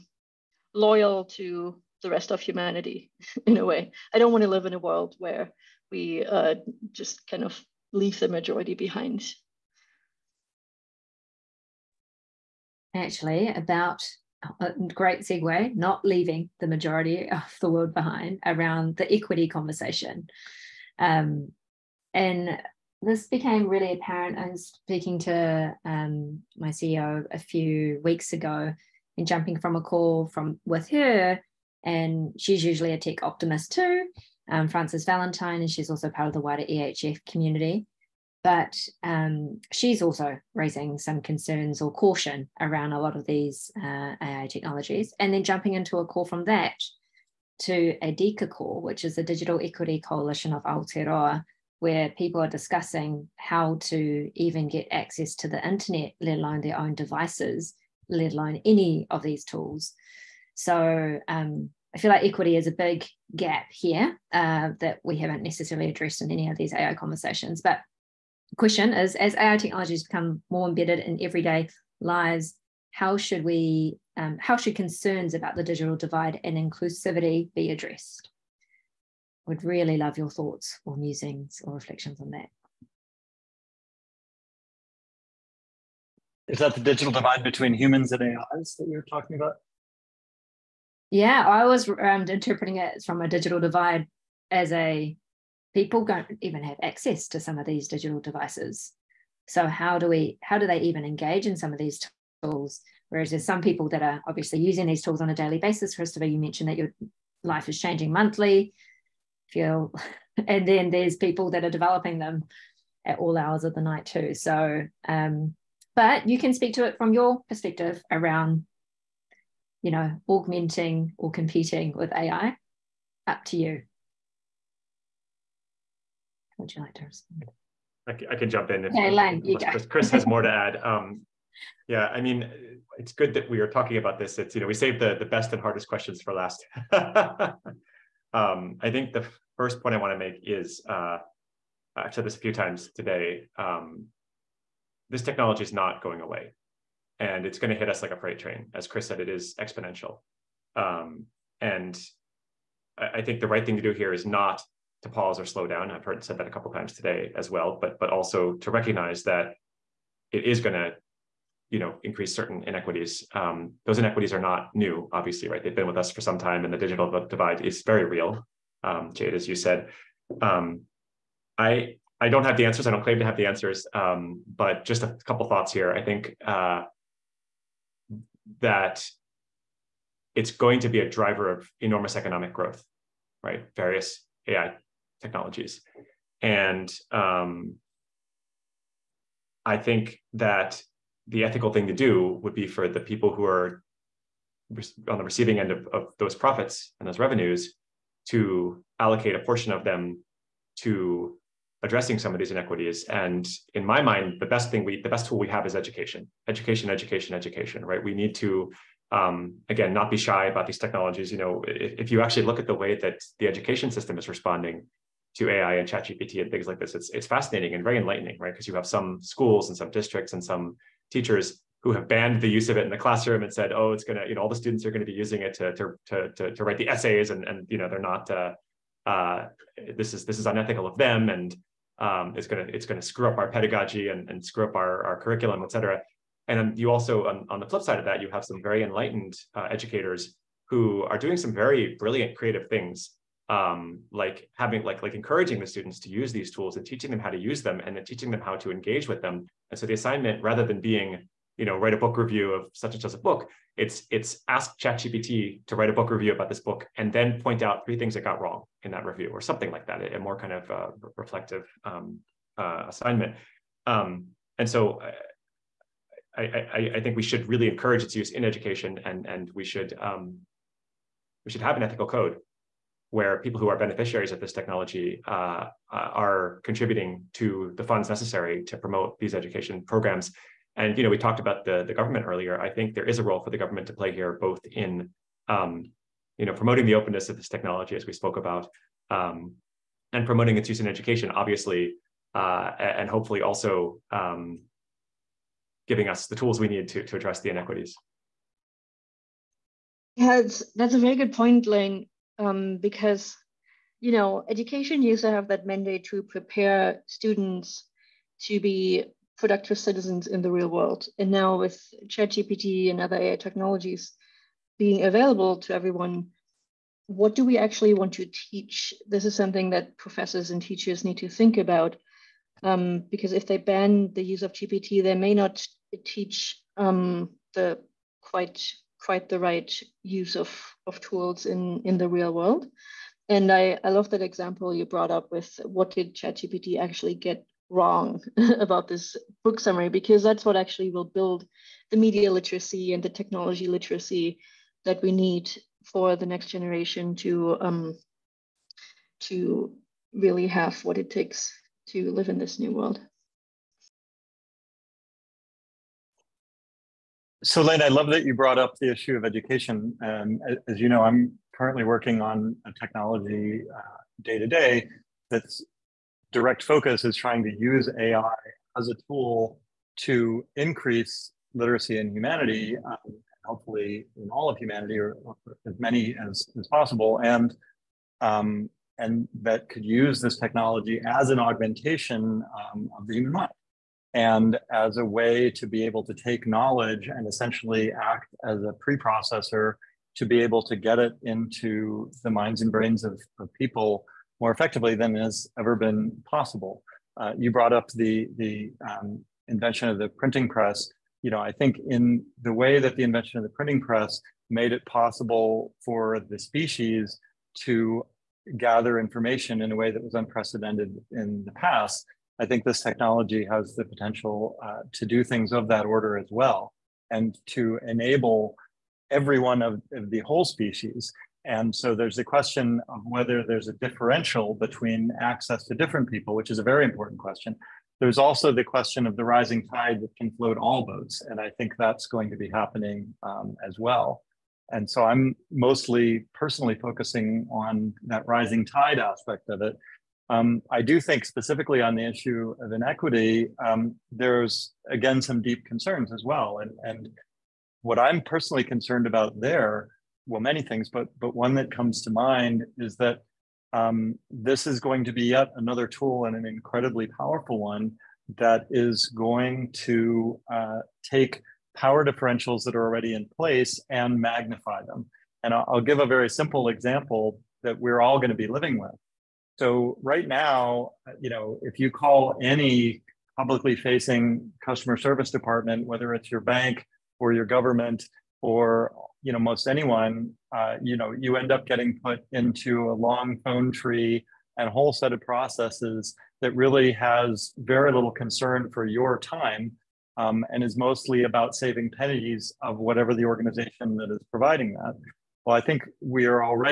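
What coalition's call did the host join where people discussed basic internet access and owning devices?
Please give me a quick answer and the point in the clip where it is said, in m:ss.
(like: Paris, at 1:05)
Digital Equity Coalition of Aotearoa, at 0:49.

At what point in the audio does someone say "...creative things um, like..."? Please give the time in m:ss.
4:02.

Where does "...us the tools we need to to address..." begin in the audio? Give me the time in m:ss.
4:56.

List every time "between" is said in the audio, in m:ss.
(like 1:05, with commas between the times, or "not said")
1:27, 7:04.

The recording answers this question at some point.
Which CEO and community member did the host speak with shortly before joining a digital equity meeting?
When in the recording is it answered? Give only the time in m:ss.
0:34.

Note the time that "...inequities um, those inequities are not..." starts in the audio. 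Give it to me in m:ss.
2:42.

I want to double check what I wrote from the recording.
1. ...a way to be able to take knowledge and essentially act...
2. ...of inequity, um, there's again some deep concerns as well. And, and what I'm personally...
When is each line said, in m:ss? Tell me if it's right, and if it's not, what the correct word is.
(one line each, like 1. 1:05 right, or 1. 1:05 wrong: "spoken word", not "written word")
1. 6:24 right
2. 7:22 right.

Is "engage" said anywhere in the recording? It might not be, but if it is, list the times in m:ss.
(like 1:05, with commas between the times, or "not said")
1:41, 4:08.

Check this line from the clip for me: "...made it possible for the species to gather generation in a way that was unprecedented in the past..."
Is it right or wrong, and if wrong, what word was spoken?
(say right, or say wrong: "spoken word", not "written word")
wrong: "information", not "generation".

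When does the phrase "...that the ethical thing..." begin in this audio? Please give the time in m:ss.
3:10.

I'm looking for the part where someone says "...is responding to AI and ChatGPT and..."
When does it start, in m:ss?
3:34.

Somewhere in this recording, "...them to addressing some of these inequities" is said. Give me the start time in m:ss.
3:19.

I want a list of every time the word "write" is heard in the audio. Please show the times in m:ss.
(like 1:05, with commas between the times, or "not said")
3:46, 4:11, 4:15.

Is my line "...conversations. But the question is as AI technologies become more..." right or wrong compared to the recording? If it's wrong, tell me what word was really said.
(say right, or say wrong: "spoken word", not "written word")
right.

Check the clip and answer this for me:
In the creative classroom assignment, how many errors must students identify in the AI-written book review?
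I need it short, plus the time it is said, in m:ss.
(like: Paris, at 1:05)
3, at 4:17.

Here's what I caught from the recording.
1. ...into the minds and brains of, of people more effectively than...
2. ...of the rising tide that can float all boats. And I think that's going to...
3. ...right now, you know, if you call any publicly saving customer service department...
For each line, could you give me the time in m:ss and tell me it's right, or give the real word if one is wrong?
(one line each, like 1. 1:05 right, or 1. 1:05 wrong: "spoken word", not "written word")
1. 6:31 right
2. 7:09 right
3. 7:50 wrong: "facing", not "saving".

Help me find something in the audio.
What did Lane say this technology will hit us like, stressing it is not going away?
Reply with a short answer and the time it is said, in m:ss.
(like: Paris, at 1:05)
a freight train, at 2:28.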